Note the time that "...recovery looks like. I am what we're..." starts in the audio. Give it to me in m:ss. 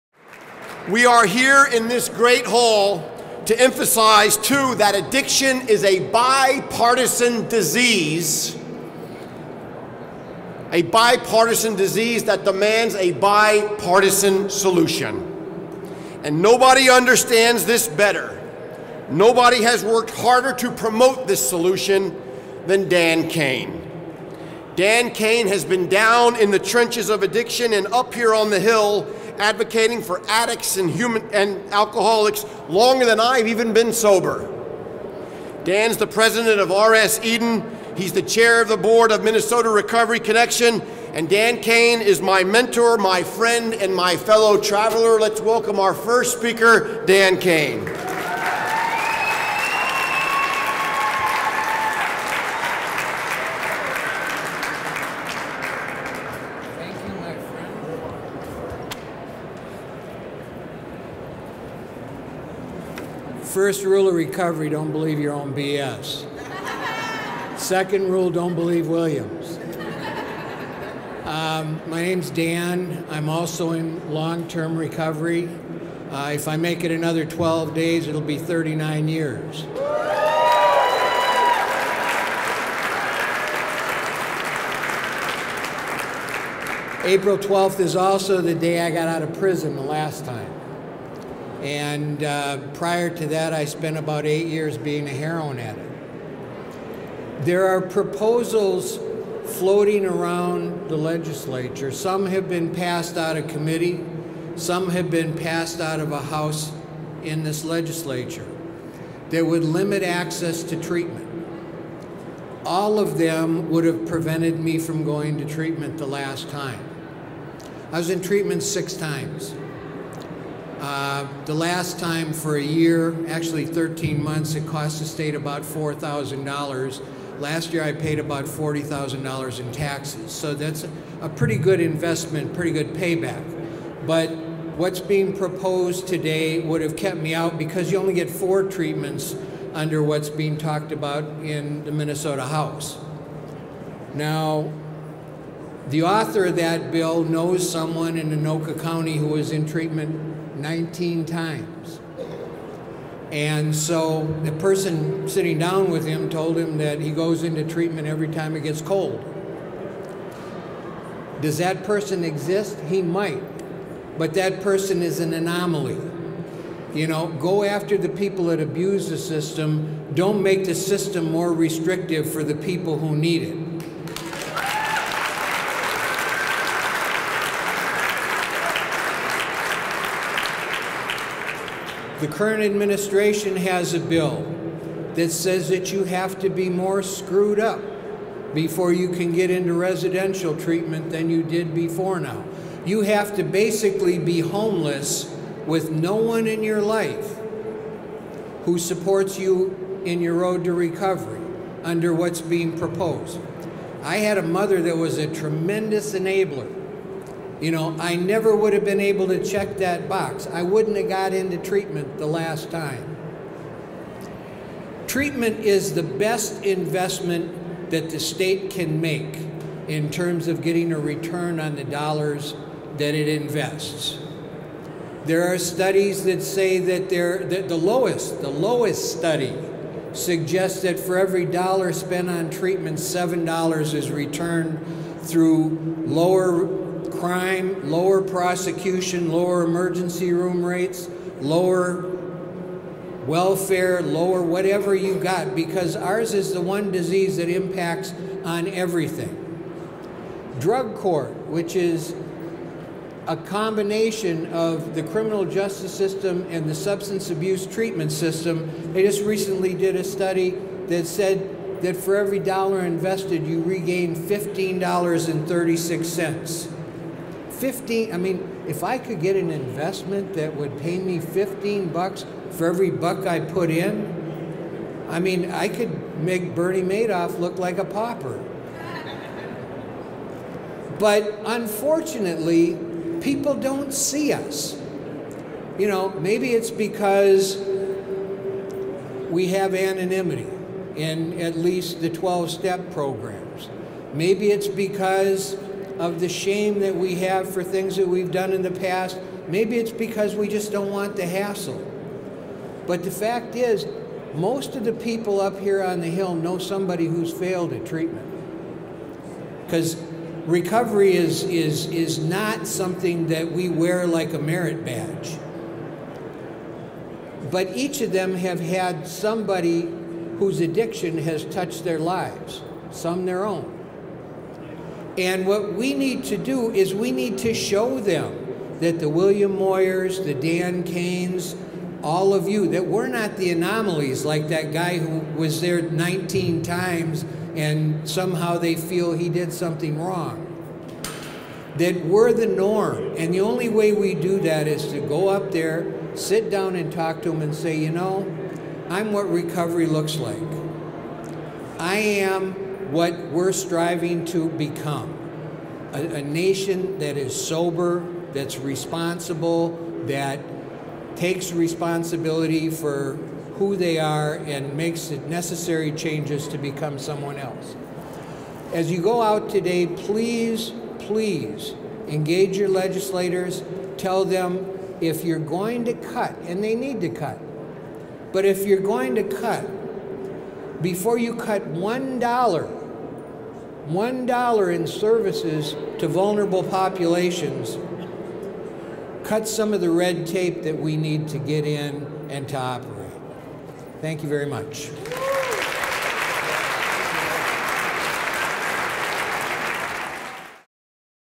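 5:49.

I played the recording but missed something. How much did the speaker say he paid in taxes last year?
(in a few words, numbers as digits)
$40,000.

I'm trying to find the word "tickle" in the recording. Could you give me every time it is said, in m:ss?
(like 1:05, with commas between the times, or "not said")
not said.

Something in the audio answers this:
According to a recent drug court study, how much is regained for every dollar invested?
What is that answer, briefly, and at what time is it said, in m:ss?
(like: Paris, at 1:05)
$15.36, at 4:24.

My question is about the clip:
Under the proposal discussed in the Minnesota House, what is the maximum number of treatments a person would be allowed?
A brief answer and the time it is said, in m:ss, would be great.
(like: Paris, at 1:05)
4, at 2:18.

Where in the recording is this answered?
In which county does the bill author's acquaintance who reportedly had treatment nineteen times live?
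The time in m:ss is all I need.
2:28.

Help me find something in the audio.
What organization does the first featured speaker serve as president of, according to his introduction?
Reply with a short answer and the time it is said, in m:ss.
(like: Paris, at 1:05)
RS Eden, at 0:36.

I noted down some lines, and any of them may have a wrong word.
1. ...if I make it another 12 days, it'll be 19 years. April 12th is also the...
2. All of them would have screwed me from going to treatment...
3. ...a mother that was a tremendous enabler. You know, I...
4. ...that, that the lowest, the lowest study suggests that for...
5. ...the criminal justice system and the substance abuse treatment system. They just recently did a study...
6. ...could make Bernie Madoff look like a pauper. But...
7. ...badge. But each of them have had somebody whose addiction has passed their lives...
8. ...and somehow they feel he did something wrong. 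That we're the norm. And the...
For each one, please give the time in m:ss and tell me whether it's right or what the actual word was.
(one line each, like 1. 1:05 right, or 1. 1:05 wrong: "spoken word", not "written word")
1. 1:16 wrong: "39", not "19"
2. 1:52 wrong: "prevented", not "screwed"
3. 3:24 right
4. 3:46 right
5. 4:14 right
6. 4:35 right
7. 5:14 wrong: "touched", not "passed"
8. 5:37 right.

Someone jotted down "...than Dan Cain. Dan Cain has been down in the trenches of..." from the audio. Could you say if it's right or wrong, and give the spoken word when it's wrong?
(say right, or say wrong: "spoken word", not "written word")
right.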